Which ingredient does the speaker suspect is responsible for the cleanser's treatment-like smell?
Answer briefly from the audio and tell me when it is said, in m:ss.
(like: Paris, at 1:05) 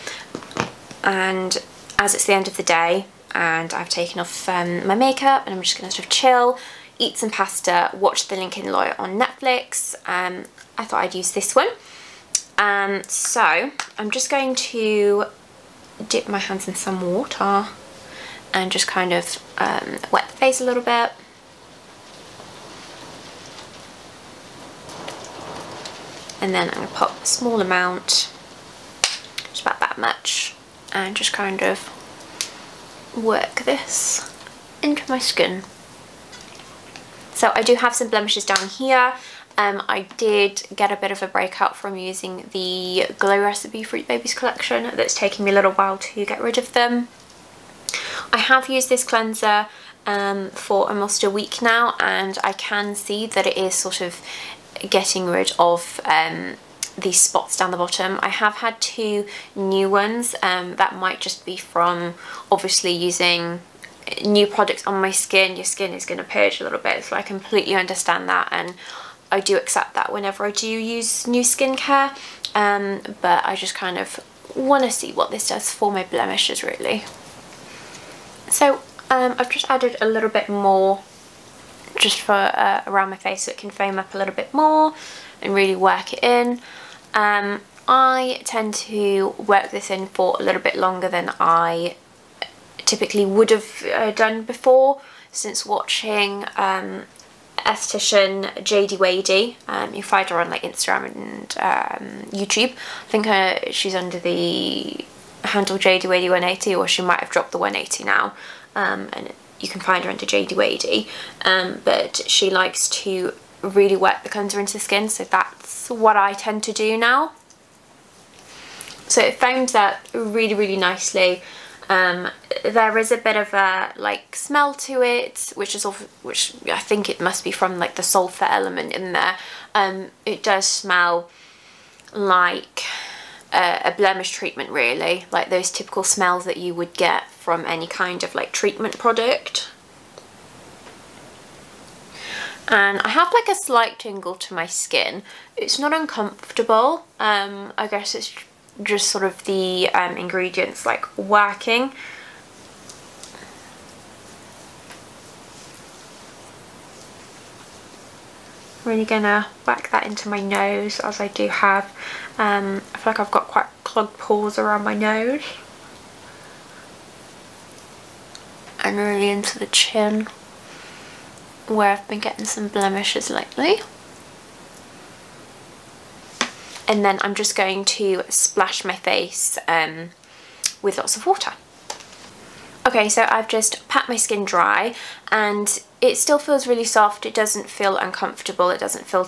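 sulfur, at 2:08.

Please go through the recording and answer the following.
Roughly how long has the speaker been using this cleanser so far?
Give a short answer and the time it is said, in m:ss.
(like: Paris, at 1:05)
almost a week, at 0:50.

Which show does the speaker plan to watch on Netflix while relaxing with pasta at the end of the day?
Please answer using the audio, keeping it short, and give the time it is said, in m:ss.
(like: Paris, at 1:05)
The Lincoln Lawyer, at 0:08.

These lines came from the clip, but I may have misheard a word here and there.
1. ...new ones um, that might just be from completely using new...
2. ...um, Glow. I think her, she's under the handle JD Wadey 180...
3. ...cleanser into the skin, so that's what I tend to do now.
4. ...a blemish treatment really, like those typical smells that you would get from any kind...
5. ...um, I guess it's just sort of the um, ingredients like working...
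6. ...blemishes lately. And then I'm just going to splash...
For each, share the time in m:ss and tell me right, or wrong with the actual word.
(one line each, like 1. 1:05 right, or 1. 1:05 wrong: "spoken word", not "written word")
1. 0:59 wrong: "obviously", not "completely"
2. 1:41 wrong: "YouTube", not "Glow"
3. 1:54 right
4. 2:13 right
5. 2:27 right
6. 2:52 right.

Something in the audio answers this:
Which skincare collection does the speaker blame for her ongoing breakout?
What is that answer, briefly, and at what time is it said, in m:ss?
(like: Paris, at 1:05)
Fruit Babies, at 0:43.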